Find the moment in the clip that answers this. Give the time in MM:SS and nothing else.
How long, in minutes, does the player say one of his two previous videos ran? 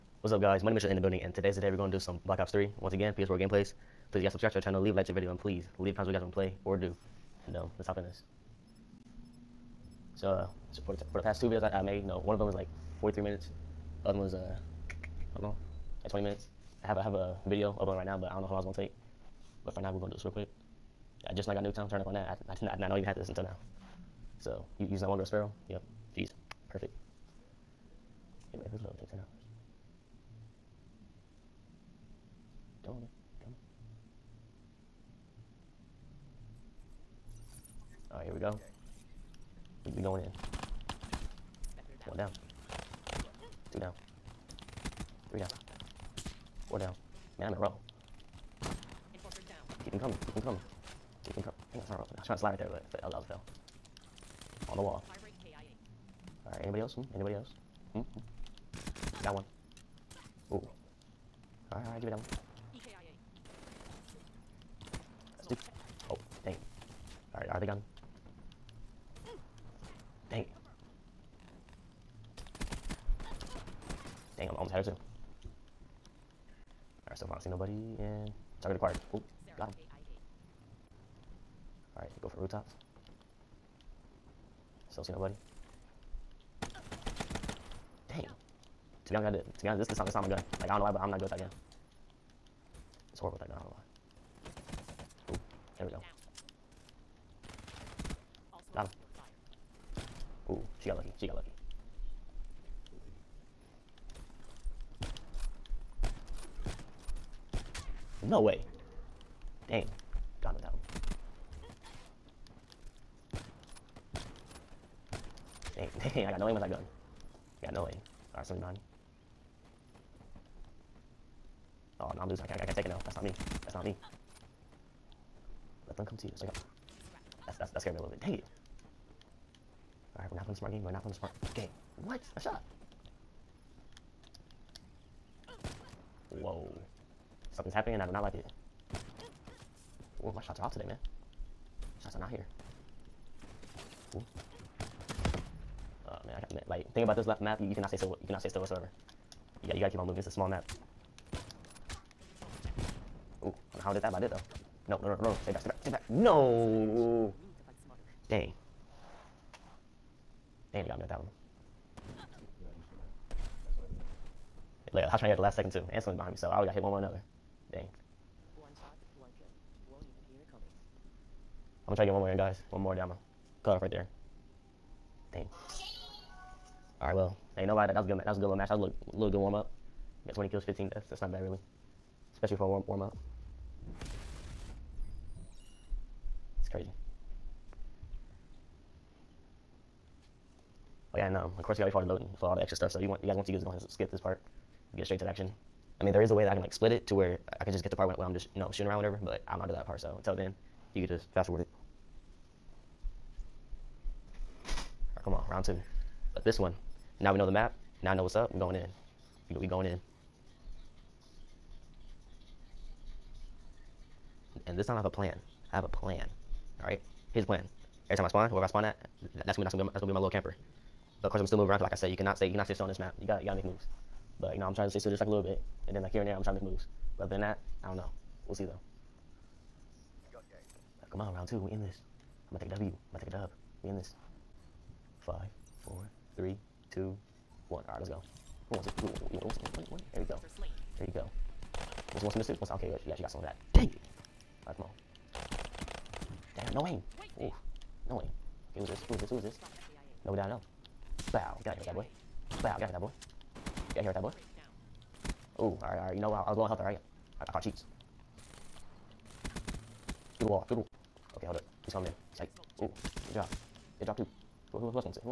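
00:13.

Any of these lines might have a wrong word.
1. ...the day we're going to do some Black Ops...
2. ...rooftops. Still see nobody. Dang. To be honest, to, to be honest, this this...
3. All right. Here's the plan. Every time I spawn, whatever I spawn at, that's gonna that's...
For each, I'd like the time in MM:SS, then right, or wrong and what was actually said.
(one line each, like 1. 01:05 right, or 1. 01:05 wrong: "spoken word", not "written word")
1. 00:01 right
2. 01:22 right
3. 03:36 wrong: "whoever", not "whatever".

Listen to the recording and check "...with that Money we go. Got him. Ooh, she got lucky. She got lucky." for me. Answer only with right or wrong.
wrong.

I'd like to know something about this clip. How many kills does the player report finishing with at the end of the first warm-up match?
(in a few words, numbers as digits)
20.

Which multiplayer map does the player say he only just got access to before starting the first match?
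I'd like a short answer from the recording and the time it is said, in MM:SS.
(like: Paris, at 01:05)
Nuketown, at 00:21.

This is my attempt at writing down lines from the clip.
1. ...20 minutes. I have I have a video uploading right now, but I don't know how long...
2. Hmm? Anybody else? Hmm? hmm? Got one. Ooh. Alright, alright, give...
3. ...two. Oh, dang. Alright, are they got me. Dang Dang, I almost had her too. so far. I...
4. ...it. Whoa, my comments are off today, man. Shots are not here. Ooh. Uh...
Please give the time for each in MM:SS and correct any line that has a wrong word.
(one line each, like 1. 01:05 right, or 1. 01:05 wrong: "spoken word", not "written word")
1. 00:16 right
2. 00:56 right
3. 01:05 right
4. 02:18 wrong: "shots", not "comments".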